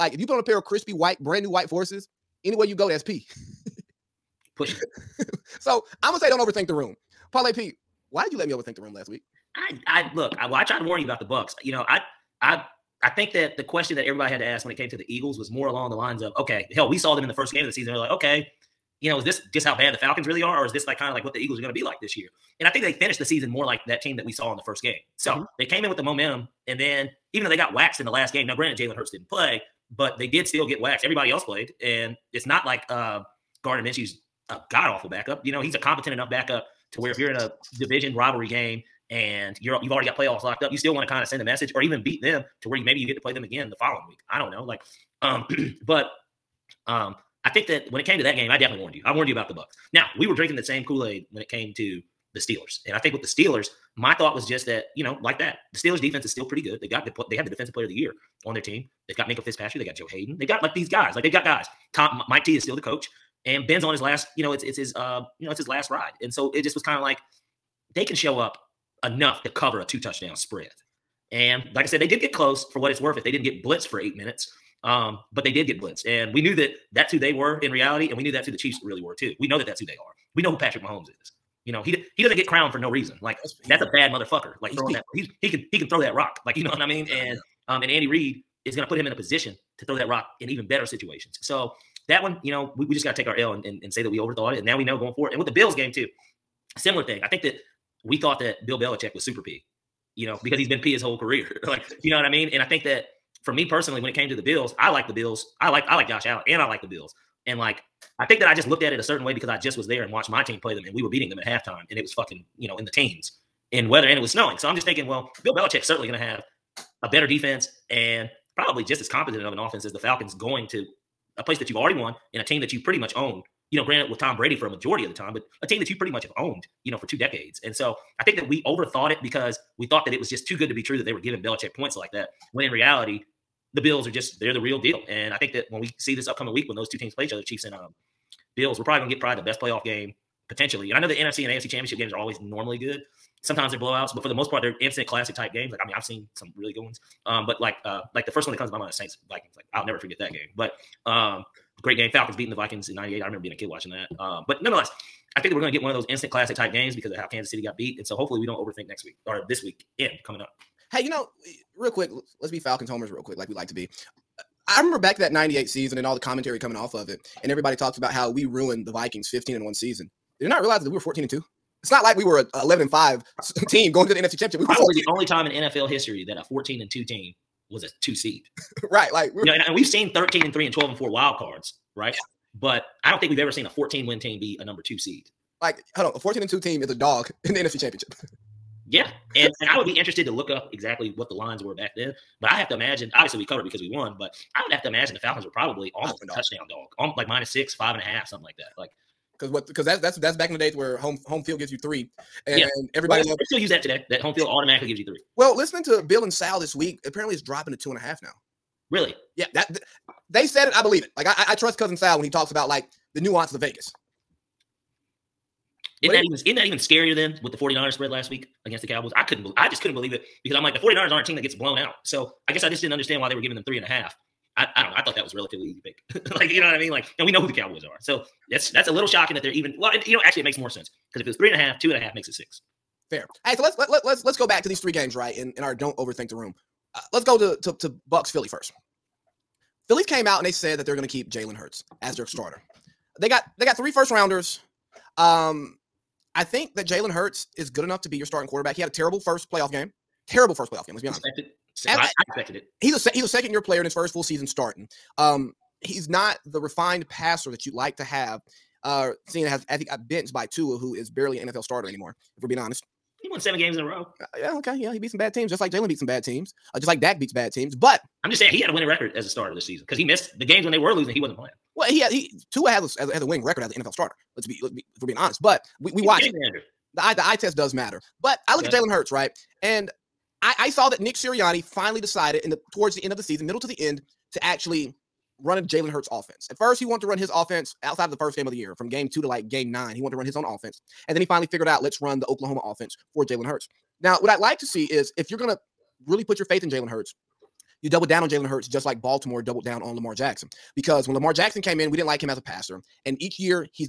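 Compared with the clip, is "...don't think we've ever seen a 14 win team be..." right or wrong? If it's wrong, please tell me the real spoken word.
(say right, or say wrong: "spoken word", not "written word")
right.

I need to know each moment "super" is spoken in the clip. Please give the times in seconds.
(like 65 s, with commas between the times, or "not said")
99 s.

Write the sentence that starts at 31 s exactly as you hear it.
Everybody else played, and it's not like uh, Gardner Minshew's a god awful backup.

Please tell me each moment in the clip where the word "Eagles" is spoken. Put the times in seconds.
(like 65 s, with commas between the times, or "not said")
15 s, 21 s.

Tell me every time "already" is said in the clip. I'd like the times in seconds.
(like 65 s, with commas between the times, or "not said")
39 s, 121 s.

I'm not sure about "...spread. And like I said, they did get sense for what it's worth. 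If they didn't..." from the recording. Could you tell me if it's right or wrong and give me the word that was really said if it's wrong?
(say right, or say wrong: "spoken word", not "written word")
wrong: "close", not "sense".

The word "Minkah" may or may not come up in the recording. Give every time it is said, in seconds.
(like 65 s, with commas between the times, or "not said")
59 s.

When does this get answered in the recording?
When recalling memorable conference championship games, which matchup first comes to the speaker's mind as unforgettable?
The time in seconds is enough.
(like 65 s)
148 s.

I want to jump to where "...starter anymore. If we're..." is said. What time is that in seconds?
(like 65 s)
261 s.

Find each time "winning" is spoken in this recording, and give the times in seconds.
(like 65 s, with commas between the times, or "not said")
268 s, 273 s.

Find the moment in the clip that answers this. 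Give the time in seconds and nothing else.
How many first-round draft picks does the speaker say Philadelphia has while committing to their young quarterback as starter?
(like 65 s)
243 s.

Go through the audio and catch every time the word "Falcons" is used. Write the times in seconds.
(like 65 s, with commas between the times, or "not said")
19 s, 119 s, 152 s, 162 s, 195 s.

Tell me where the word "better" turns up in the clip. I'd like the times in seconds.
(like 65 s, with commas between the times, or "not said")
90 s, 117 s.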